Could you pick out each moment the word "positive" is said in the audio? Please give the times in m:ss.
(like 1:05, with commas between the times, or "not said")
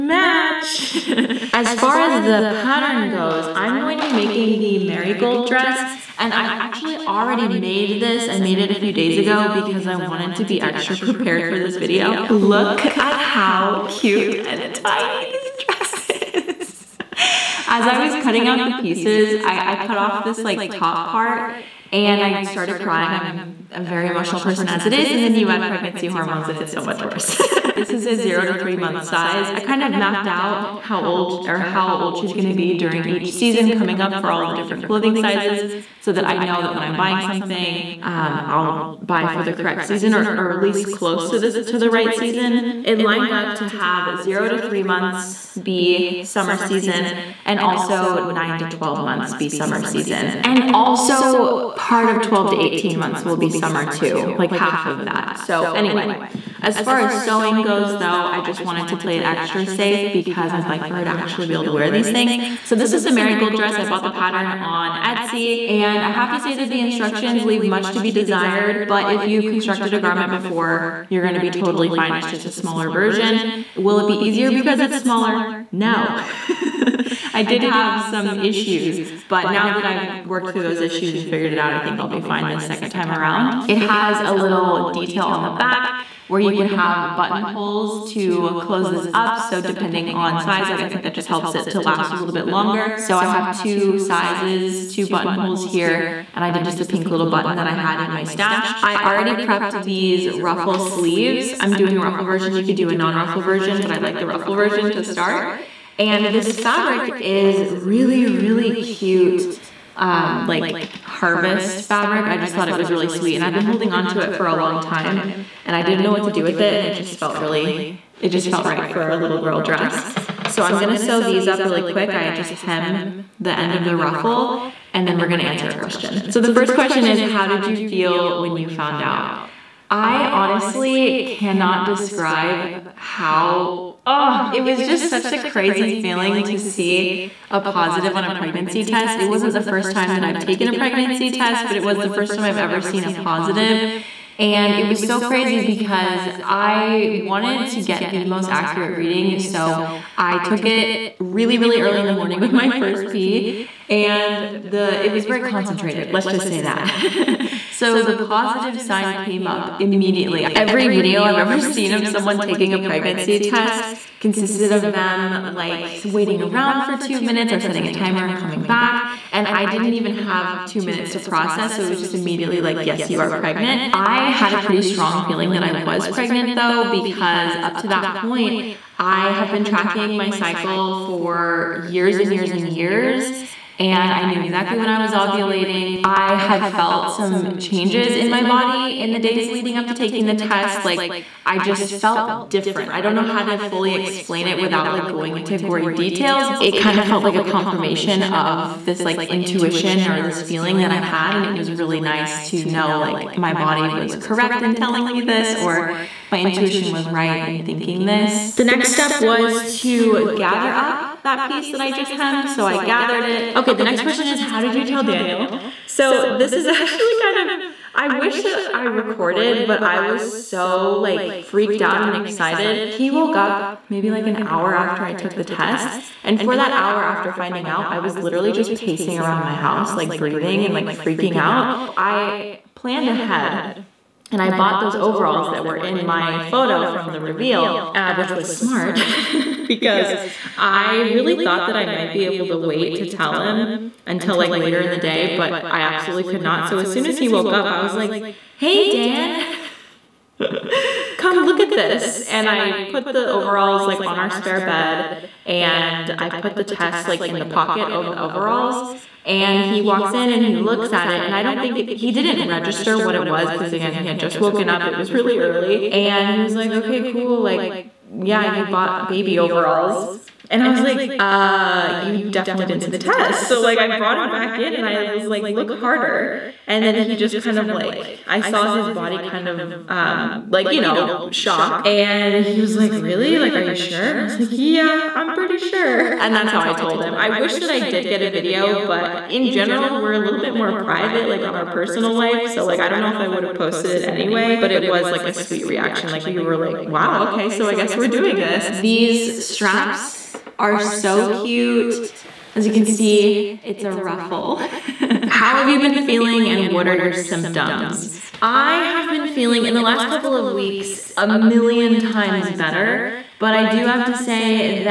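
2:17, 2:23, 2:38.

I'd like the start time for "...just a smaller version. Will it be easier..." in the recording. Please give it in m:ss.
1:12.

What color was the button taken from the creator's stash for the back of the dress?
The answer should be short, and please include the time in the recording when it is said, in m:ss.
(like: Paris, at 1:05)
Pink, at 1:36.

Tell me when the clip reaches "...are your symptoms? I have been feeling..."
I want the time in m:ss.
5:06.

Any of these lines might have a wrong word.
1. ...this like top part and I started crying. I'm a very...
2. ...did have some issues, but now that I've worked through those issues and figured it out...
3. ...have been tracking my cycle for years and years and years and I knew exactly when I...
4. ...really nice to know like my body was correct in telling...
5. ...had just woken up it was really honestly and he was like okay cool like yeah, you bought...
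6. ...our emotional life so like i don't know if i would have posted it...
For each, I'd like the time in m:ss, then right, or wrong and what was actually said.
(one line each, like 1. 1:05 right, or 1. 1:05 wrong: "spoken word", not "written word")
1. 0:20 right
2. 1:17 right
3. 2:59 right
4. 3:21 right
5. 4:24 wrong: "early", not "honestly"
6. 4:51 wrong: "personal", not "emotional".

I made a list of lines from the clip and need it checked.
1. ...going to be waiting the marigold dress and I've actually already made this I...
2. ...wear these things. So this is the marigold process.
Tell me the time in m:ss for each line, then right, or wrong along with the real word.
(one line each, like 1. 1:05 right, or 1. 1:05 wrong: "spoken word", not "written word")
1. 0:03 wrong: "making", not "waiting"
2. 1:01 wrong: "dress", not "process".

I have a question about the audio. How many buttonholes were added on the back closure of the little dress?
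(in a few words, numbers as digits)
2.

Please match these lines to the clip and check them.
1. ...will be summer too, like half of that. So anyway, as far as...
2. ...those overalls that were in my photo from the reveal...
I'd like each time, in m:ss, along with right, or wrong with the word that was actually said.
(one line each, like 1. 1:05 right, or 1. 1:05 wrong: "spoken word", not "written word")
1. 0:53 right
2. 3:54 right.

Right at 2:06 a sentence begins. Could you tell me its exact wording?
So the first question is, how did you feel when you found out?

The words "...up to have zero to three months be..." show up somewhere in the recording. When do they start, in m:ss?
0:43.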